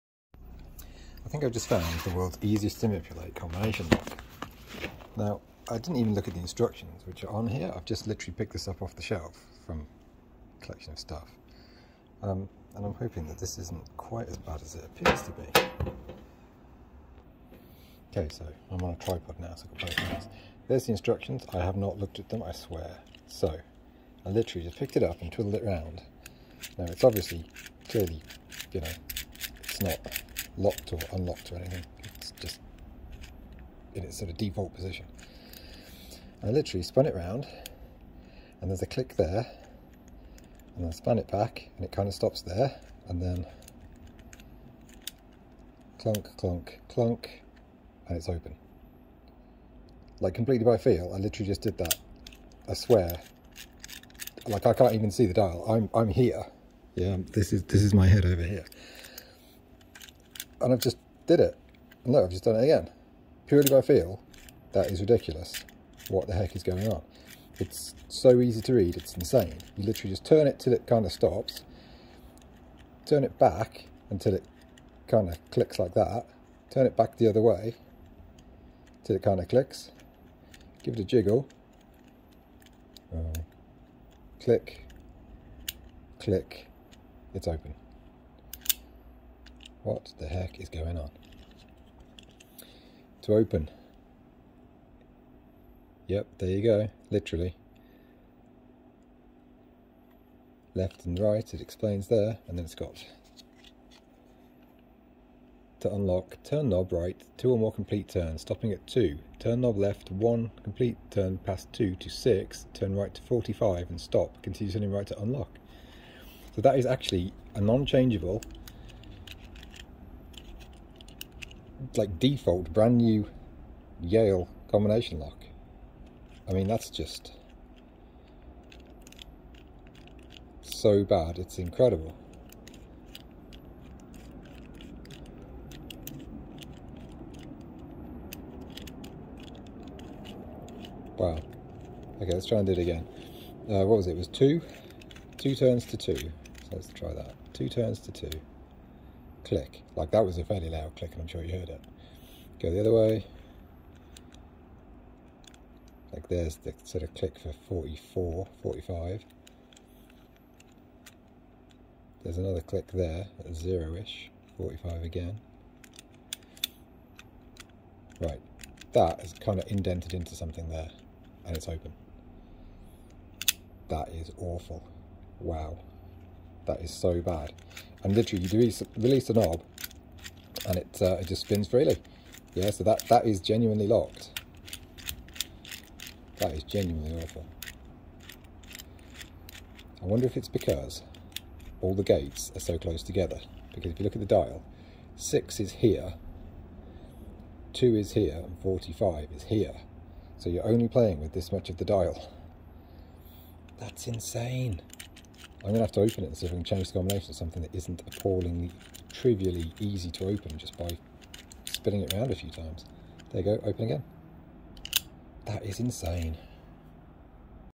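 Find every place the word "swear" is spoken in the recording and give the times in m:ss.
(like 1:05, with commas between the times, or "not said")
0:22, 0:52.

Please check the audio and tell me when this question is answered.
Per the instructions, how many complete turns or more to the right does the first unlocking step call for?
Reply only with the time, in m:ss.
1:47.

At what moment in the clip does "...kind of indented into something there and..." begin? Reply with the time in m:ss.
2:49.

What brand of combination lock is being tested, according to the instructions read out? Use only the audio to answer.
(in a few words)
Yale.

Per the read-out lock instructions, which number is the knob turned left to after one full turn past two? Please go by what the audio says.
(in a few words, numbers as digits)
6.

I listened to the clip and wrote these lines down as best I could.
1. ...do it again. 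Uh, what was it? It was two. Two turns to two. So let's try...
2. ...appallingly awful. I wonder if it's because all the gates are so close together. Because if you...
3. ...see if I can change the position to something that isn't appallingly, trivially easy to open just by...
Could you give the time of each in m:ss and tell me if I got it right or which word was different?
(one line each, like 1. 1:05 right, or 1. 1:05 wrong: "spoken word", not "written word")
1. 2:22 right
2. 3:06 wrong: "genuinely", not "appallingly"
3. 3:26 wrong: "combination", not "position".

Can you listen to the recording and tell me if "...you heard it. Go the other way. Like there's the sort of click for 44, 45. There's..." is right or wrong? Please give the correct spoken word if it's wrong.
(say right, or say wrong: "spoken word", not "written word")
right.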